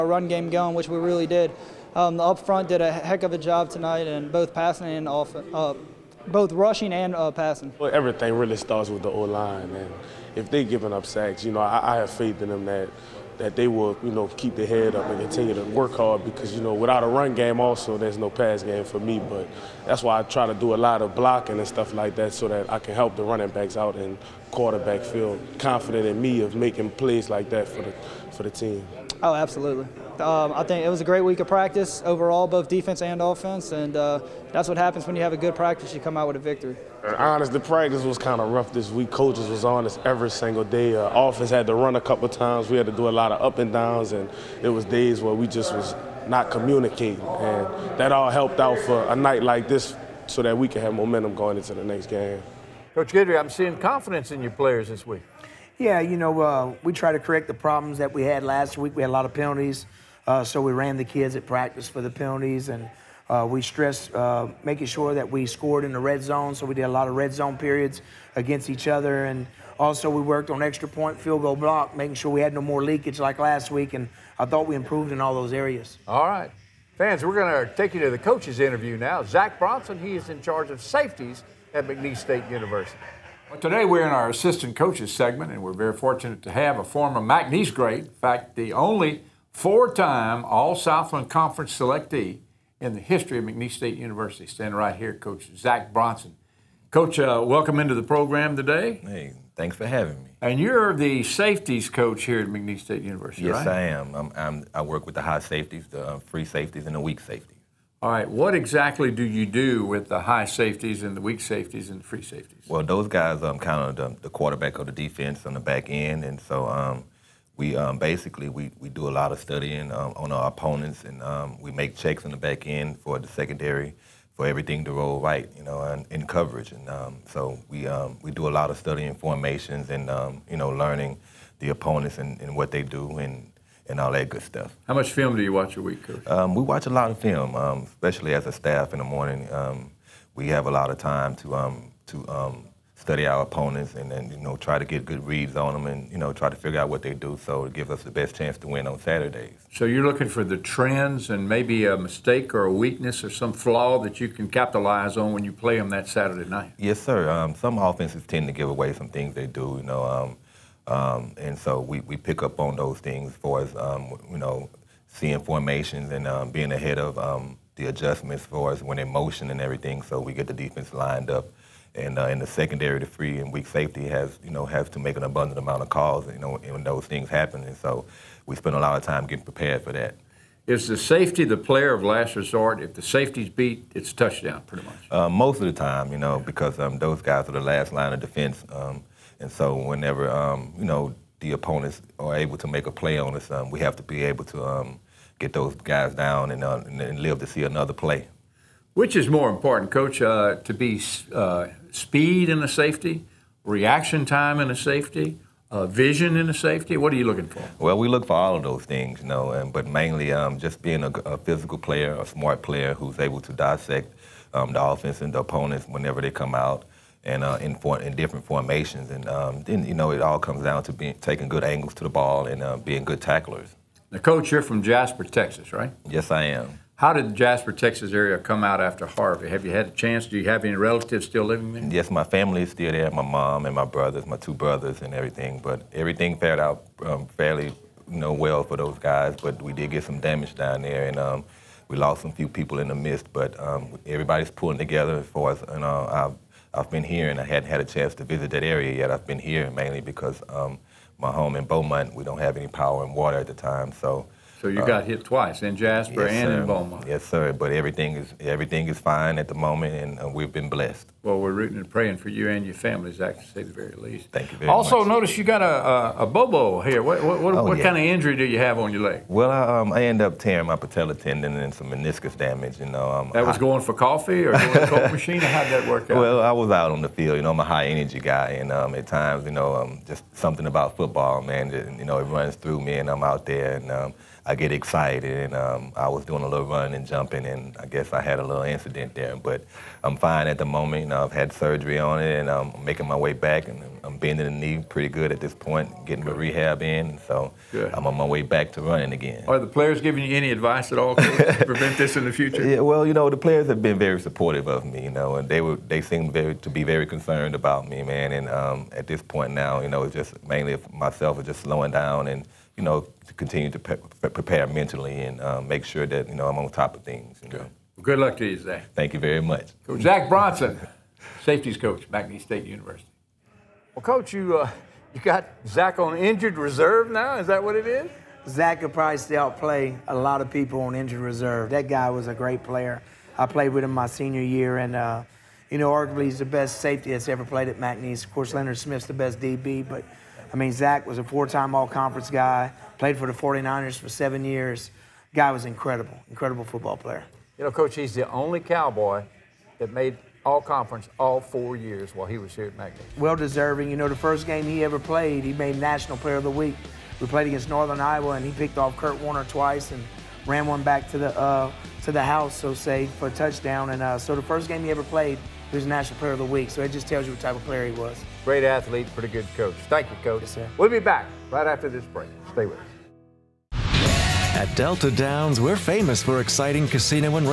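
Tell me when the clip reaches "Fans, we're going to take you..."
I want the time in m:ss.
1:16.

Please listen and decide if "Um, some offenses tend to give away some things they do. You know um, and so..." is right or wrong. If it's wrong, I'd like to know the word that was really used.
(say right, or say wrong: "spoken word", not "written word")
right.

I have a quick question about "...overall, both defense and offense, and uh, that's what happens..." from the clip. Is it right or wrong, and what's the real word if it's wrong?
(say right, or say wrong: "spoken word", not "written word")
right.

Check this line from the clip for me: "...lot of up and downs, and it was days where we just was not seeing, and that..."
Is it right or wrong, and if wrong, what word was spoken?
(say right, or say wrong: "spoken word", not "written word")
wrong: "communicating", not "seeing".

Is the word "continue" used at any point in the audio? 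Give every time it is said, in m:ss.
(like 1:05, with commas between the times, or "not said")
0:15, 5:13.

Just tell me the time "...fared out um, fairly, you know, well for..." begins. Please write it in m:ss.
3:56.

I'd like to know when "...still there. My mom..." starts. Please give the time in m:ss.
3:52.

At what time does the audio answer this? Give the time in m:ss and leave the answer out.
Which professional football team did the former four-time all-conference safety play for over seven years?
5:43.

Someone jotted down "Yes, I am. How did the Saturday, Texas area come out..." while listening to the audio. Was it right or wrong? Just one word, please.
wrong.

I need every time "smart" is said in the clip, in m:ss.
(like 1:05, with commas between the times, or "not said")
3:32.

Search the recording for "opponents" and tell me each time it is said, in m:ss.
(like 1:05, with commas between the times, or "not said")
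2:00, 2:11, 2:23, 3:11, 3:35.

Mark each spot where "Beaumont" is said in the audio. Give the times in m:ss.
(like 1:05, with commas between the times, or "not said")
4:11, 4:16.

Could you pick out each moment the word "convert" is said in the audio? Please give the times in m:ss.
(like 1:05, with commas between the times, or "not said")
not said.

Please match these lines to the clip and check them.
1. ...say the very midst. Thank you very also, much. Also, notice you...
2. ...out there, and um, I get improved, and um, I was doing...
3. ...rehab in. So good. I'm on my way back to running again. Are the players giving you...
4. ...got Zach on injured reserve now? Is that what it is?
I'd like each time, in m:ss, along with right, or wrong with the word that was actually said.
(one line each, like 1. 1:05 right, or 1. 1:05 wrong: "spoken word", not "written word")
1. 4:23 wrong: "least", not "midst"
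2. 4:43 wrong: "excited", not "improved"
3. 4:56 right
4. 5:25 right.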